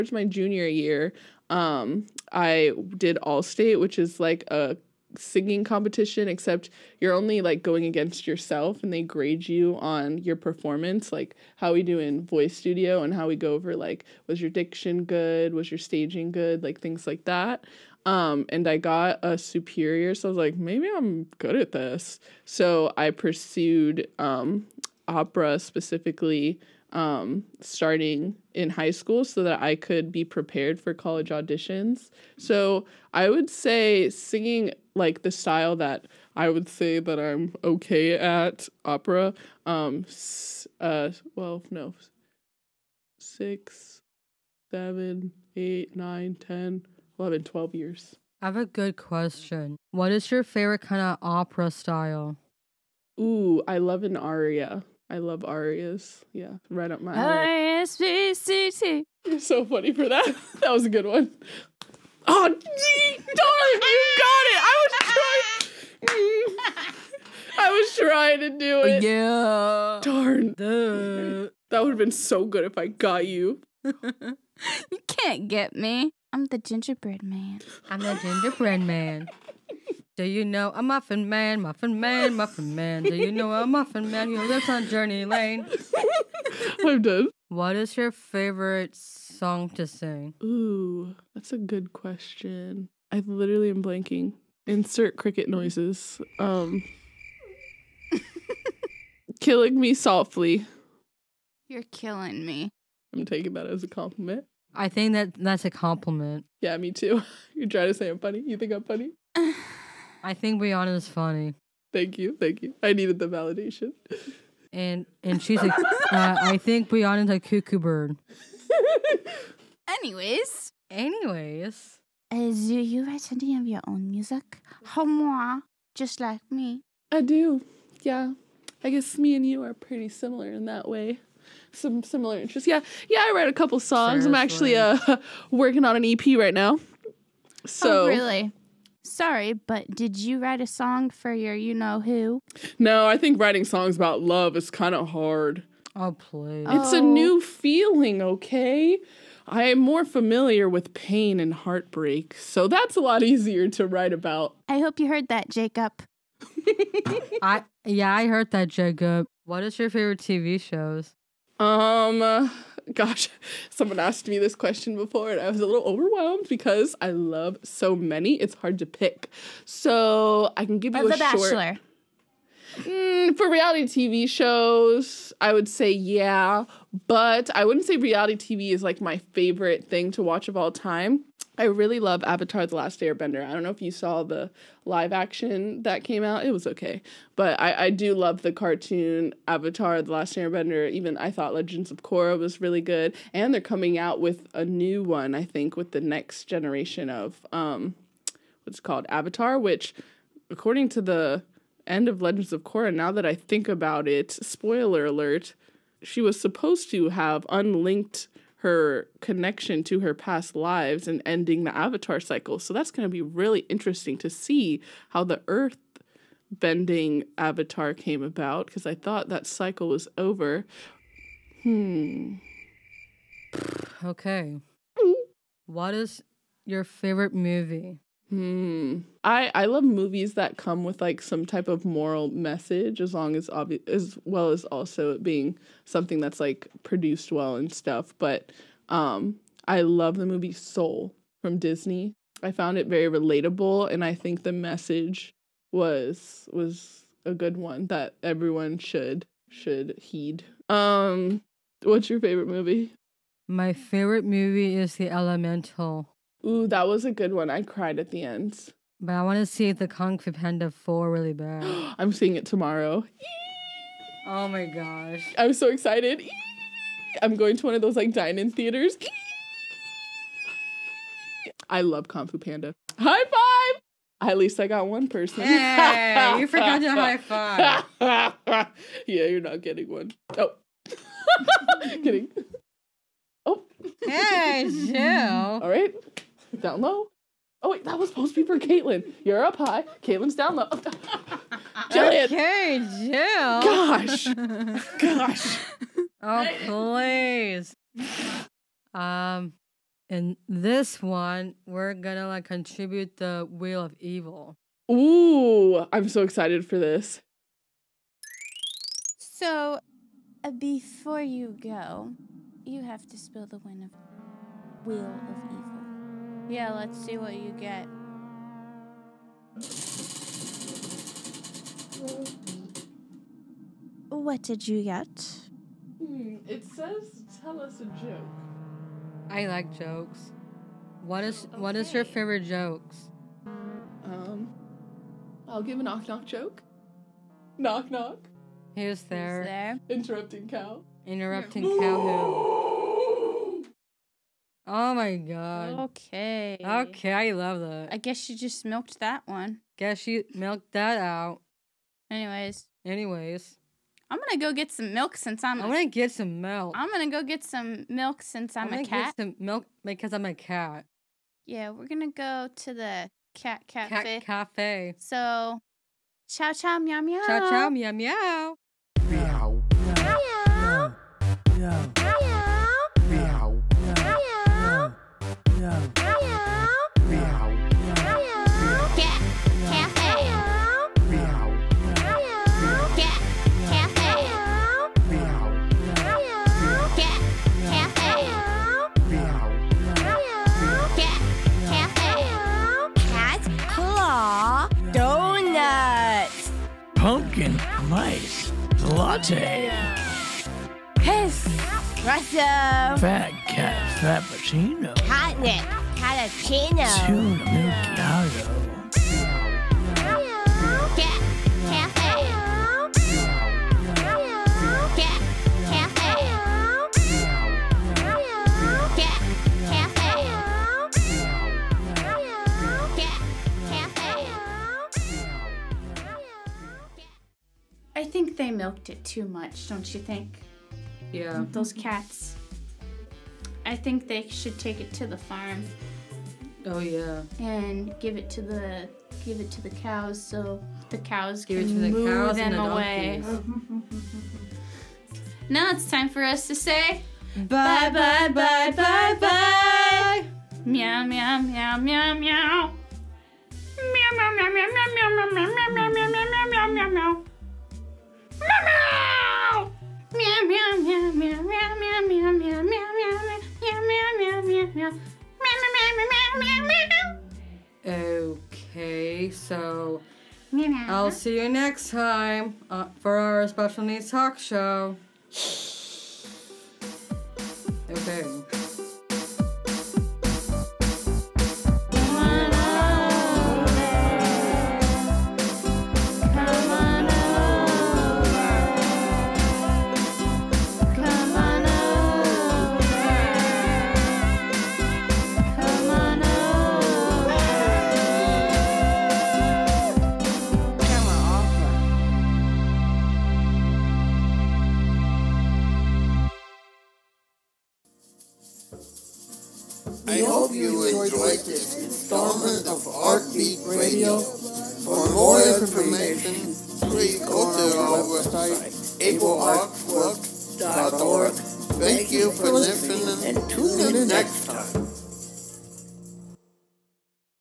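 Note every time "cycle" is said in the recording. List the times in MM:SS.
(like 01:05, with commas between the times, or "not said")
03:32, 03:39.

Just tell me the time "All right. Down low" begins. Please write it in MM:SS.
04:45.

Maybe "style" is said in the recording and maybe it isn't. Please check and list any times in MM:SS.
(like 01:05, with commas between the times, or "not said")
00:35, 00:51.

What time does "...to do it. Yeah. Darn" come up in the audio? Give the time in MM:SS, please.
01:08.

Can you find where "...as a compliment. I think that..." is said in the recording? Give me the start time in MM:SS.
01:43.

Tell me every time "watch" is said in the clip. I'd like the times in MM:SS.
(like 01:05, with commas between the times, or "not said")
03:00.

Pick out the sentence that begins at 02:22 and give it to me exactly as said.
No, I think writing songs about love is kind of hard.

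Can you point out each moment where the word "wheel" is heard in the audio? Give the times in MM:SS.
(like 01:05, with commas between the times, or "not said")
05:03, 05:14.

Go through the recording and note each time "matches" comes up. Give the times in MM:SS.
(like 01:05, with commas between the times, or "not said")
not said.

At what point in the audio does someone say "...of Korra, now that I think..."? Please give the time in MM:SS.
03:22.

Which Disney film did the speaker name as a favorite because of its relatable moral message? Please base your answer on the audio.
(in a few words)
Soul.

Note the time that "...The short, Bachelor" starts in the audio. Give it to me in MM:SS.
02:51.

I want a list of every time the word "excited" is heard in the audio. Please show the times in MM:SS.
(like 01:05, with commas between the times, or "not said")
04:25, 05:06.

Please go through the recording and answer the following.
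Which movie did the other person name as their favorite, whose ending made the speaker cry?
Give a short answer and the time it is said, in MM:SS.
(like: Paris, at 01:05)
Elemental, at 04:14.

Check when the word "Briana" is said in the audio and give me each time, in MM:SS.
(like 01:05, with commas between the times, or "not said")
01:50, 01:56.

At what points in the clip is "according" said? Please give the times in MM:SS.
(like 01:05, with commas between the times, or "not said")
03:20.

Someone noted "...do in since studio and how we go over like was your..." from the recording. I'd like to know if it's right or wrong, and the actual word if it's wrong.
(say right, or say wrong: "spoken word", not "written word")
wrong: "voice", not "since".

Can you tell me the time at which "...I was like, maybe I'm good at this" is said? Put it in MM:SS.
00:20.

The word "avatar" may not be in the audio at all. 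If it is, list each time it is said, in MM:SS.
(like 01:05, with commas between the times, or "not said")
03:02, 03:09, 03:19, 03:31, 03:37.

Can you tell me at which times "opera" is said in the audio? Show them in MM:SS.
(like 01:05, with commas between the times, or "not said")
00:25, 00:38, 00:51.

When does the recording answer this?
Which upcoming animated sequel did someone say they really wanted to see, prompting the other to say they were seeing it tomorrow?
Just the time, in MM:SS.
04:19.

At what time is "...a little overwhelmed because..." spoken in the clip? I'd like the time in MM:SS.
02:45.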